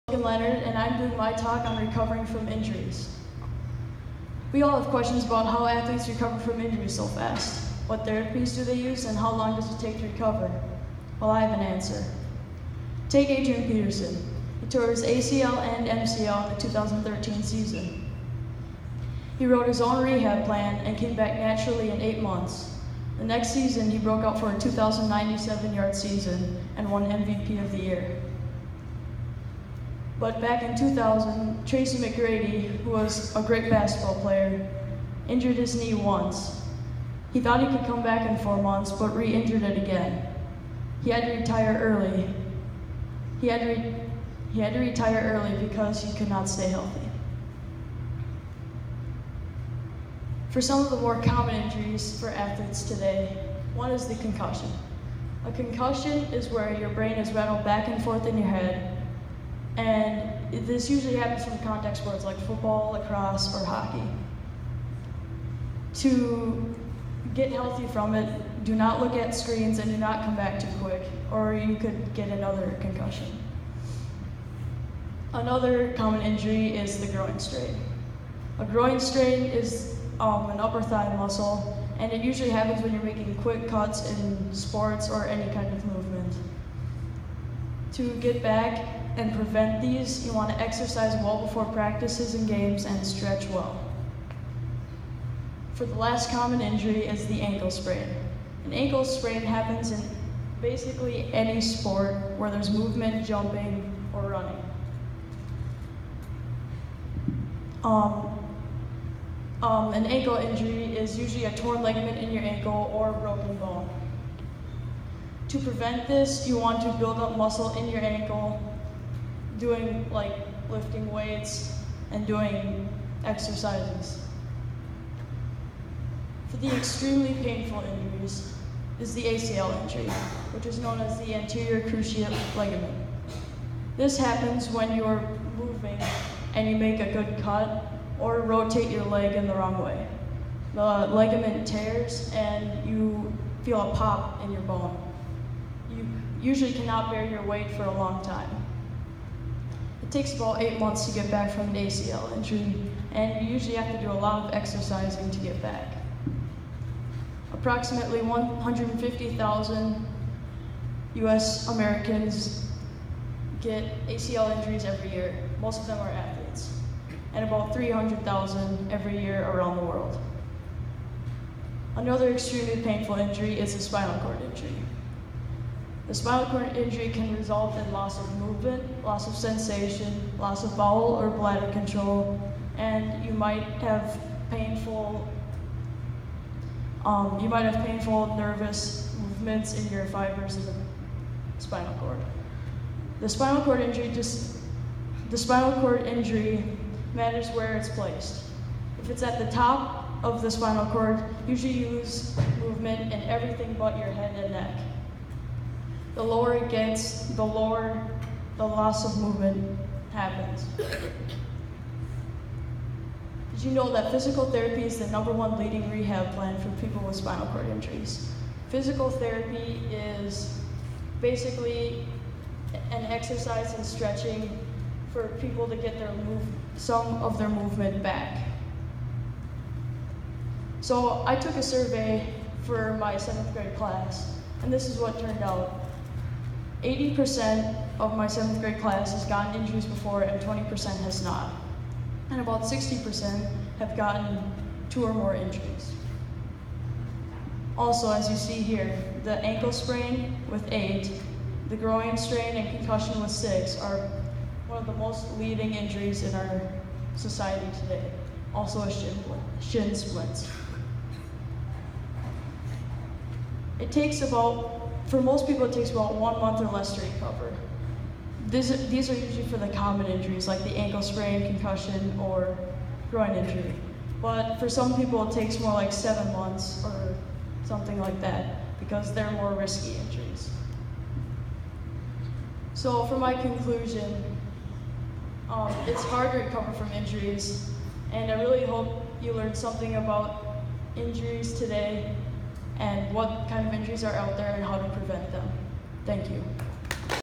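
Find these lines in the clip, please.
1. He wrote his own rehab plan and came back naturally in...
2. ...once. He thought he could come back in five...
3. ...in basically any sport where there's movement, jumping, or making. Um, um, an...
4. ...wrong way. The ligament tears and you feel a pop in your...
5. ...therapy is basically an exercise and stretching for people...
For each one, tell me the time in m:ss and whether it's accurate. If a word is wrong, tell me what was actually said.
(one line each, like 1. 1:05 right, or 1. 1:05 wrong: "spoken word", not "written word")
1. 0:19 right
2. 0:35 wrong: "four", not "five"
3. 1:39 wrong: "running", not "making"
4. 2:19 right
5. 3:39 right.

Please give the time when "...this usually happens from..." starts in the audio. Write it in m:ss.
1:00.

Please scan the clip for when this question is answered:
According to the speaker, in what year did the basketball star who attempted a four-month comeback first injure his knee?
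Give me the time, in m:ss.
0:30.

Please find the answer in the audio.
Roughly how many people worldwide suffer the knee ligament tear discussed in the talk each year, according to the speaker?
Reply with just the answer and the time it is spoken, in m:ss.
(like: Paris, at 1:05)
300,000, at 2:47.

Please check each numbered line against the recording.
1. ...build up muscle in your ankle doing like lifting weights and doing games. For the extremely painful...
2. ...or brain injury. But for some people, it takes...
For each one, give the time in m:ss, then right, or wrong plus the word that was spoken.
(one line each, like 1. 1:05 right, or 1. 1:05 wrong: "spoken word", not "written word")
1. 1:56 wrong: "exercises", not "games"
2. 4:32 wrong: "groin", not "brain".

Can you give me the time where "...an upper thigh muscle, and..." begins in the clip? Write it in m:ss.
1:20.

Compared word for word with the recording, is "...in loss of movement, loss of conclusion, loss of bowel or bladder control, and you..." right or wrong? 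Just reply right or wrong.
wrong.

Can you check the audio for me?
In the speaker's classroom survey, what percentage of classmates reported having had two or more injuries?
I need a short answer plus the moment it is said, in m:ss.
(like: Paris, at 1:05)
60%, at 4:02.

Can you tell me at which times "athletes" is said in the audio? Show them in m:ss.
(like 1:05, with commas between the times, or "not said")
0:05, 0:52, 2:46.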